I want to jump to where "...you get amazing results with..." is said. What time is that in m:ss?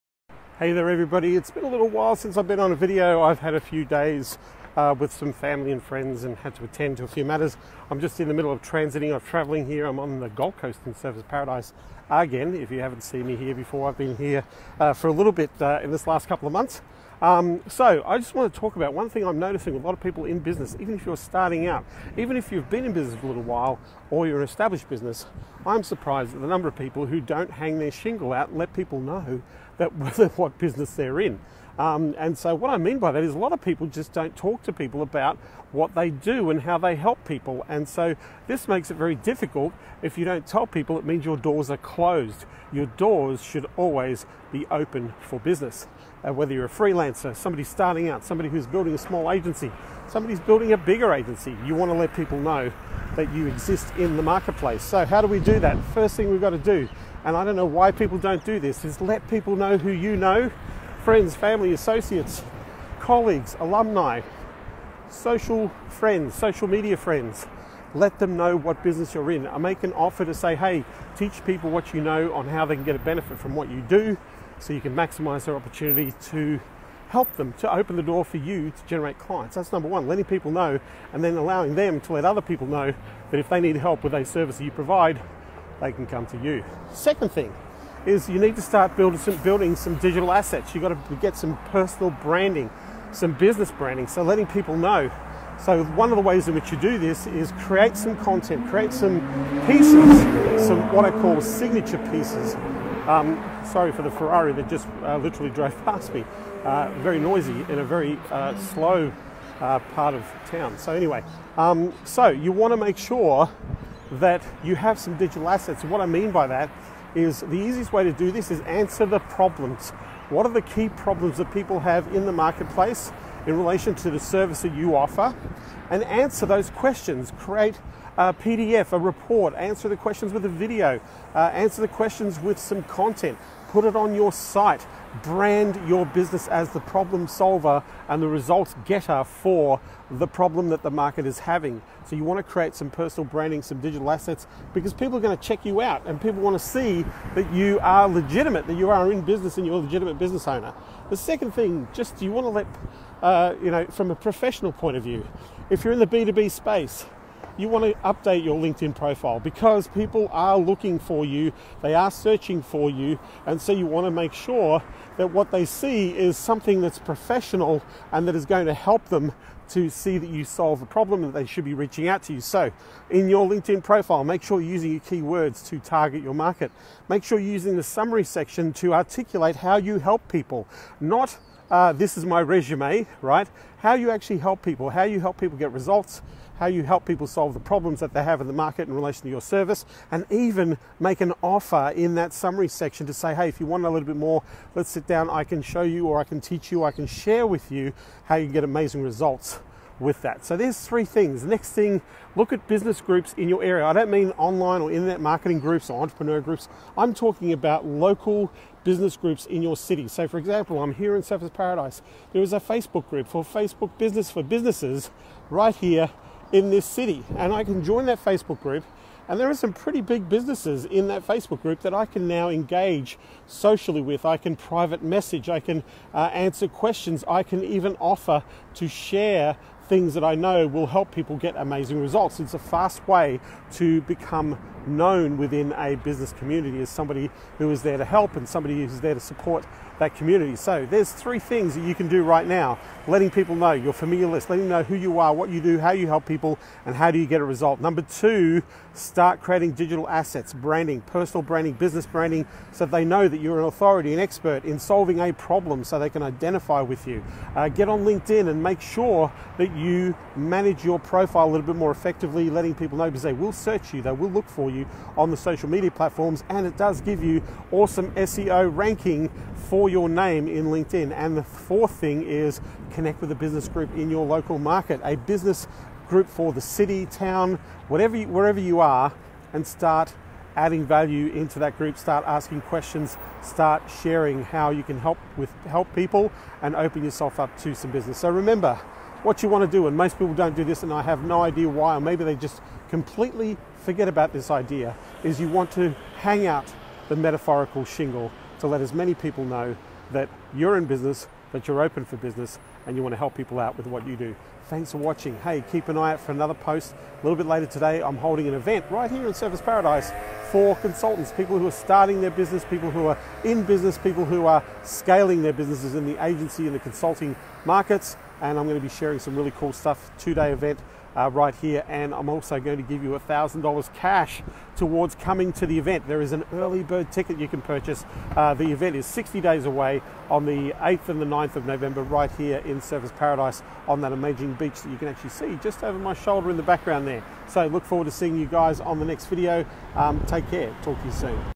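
3:18.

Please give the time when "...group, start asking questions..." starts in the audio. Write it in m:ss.
4:41.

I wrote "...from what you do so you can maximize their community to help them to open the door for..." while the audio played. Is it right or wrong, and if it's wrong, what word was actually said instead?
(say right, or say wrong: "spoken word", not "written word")
wrong: "opportunity", not "community".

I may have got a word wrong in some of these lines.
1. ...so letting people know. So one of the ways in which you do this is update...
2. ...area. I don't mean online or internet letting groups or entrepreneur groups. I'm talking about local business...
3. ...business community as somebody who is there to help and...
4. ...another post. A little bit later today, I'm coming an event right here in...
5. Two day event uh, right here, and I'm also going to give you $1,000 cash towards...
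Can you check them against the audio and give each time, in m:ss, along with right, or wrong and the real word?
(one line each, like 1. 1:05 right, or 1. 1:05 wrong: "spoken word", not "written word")
1. 1:34 wrong: "create", not "update"
2. 3:23 wrong: "marketing", not "letting"
3. 3:55 right
4. 5:06 wrong: "holding", not "coming"
5. 5:20 right.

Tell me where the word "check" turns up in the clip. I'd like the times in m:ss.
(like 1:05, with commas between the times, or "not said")
2:25.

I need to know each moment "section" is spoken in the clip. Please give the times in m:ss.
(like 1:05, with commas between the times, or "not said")
2:58, 3:12.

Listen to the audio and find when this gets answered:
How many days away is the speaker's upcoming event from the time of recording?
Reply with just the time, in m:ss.
5:29.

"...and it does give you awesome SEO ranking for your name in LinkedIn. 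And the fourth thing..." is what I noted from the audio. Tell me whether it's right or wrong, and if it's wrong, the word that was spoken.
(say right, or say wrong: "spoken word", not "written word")
right.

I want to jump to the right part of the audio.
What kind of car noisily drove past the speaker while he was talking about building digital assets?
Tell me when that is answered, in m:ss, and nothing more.
1:44.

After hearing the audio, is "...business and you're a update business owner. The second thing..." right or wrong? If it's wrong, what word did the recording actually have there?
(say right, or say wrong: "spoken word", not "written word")
wrong: "legitimate", not "update".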